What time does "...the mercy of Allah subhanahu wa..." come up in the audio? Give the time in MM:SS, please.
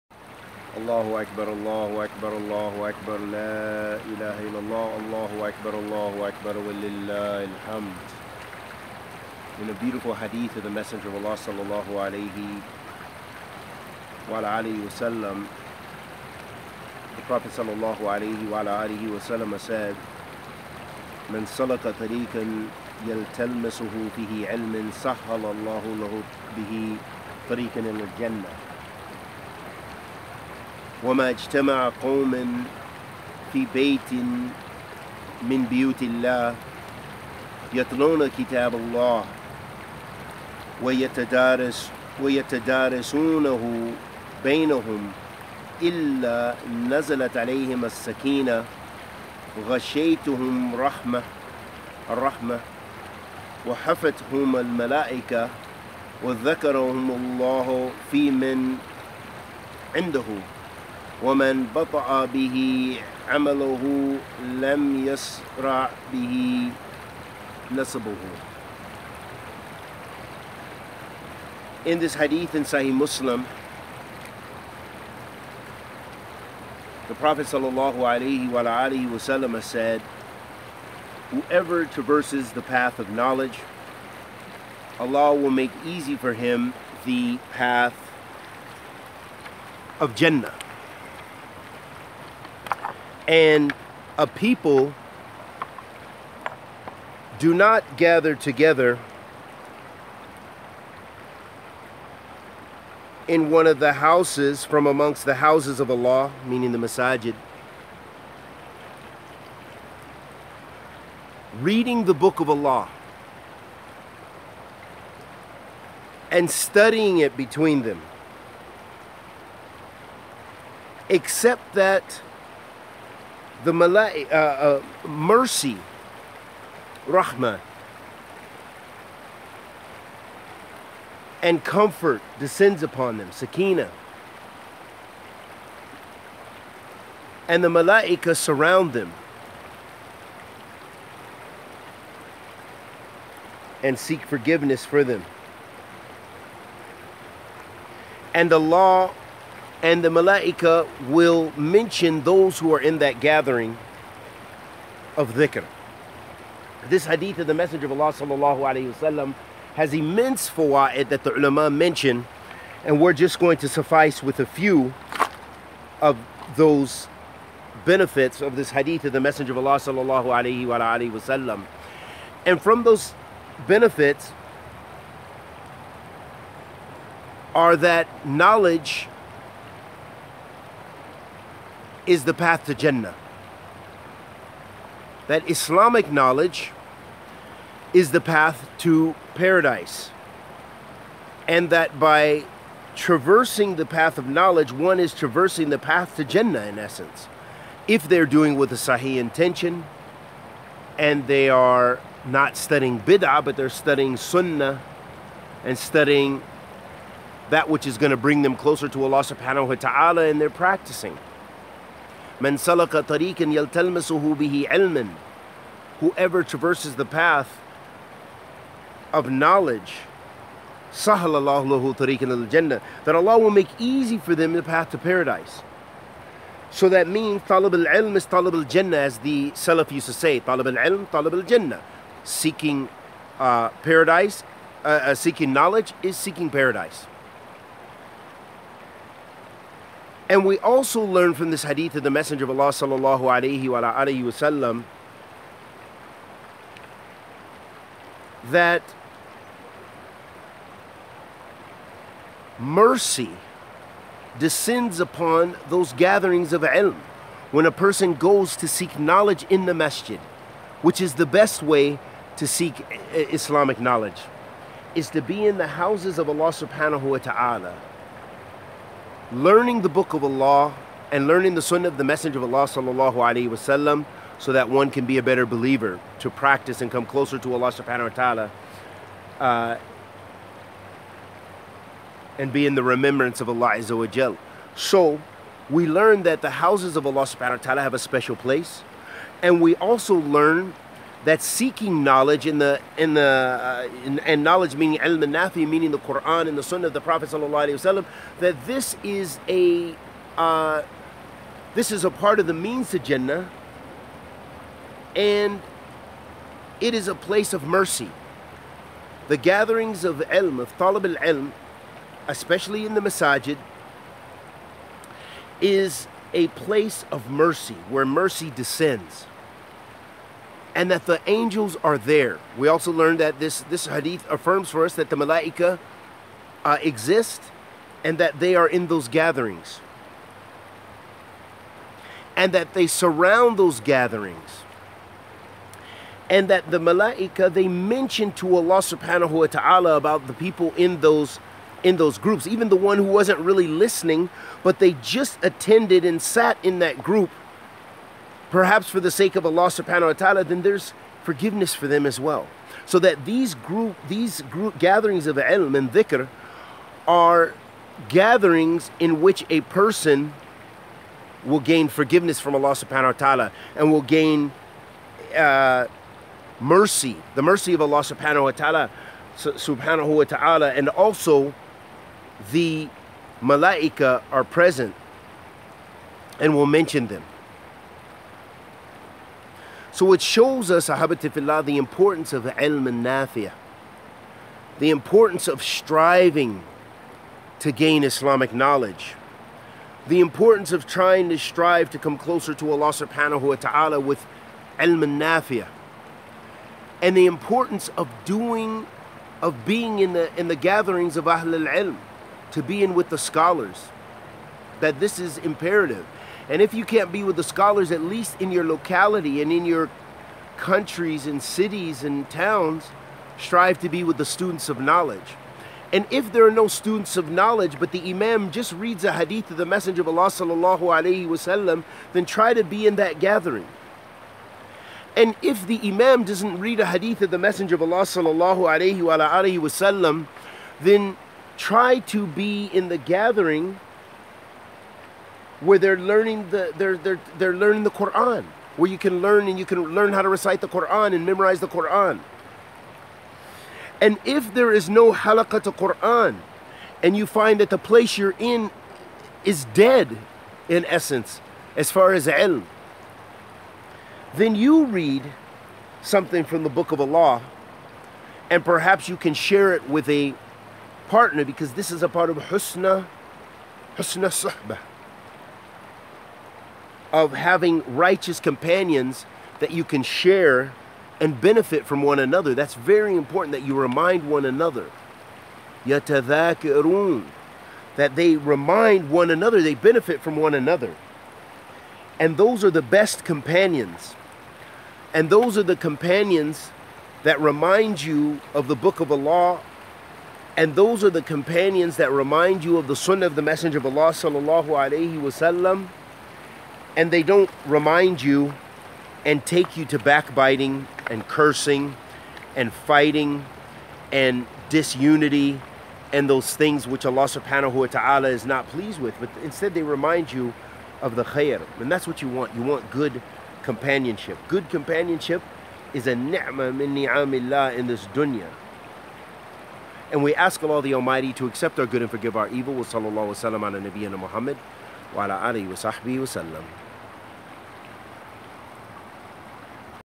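06:07.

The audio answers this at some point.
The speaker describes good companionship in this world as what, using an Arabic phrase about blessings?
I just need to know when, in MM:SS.
08:36.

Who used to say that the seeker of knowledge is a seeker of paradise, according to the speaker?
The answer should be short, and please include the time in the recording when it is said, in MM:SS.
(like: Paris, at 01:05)
the Salaf, at 03:49.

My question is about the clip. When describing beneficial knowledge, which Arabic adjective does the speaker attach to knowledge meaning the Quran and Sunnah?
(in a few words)
al nafi.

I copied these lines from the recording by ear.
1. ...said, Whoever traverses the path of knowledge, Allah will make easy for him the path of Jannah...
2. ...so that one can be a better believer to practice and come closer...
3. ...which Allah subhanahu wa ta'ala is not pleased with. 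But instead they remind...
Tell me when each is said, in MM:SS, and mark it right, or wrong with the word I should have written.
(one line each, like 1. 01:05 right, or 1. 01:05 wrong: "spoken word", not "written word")
1. 01:19 right
2. 04:34 right
3. 08:26 right.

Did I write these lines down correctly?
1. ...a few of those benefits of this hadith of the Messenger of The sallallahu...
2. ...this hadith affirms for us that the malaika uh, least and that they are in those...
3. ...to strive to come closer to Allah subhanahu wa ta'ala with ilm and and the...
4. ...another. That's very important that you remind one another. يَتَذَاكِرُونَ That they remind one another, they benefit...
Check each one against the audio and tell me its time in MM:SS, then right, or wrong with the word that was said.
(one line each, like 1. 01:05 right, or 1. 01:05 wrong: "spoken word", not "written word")
1. 02:44 wrong: "Allah", not "The"
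2. 05:23 wrong: "exist", not "least"
3. 06:31 right
4. 07:52 right.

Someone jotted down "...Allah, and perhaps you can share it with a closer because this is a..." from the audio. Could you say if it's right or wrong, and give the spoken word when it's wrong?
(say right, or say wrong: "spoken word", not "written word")
wrong: "partner", not "closer".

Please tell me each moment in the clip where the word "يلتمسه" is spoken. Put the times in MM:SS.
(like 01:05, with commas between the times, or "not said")
00:23, 03:33.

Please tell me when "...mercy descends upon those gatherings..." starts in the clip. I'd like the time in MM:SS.
04:12.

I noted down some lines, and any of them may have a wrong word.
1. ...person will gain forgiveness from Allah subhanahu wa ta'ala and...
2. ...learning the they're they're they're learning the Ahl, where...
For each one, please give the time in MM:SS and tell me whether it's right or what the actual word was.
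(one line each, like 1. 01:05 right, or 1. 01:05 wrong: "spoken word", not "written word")
1. 05:59 right
2. 07:15 wrong: "Quran", not "Ahl".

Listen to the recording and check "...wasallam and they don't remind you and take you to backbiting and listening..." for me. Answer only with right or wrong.
wrong.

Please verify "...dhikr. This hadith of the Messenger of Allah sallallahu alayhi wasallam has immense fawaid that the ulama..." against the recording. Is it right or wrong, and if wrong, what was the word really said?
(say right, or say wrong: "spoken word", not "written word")
right.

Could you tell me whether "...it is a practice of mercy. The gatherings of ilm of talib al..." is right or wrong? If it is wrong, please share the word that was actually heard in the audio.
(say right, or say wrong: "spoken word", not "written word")
wrong: "place", not "practice".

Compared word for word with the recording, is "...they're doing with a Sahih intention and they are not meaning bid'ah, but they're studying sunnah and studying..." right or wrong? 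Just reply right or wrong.
wrong.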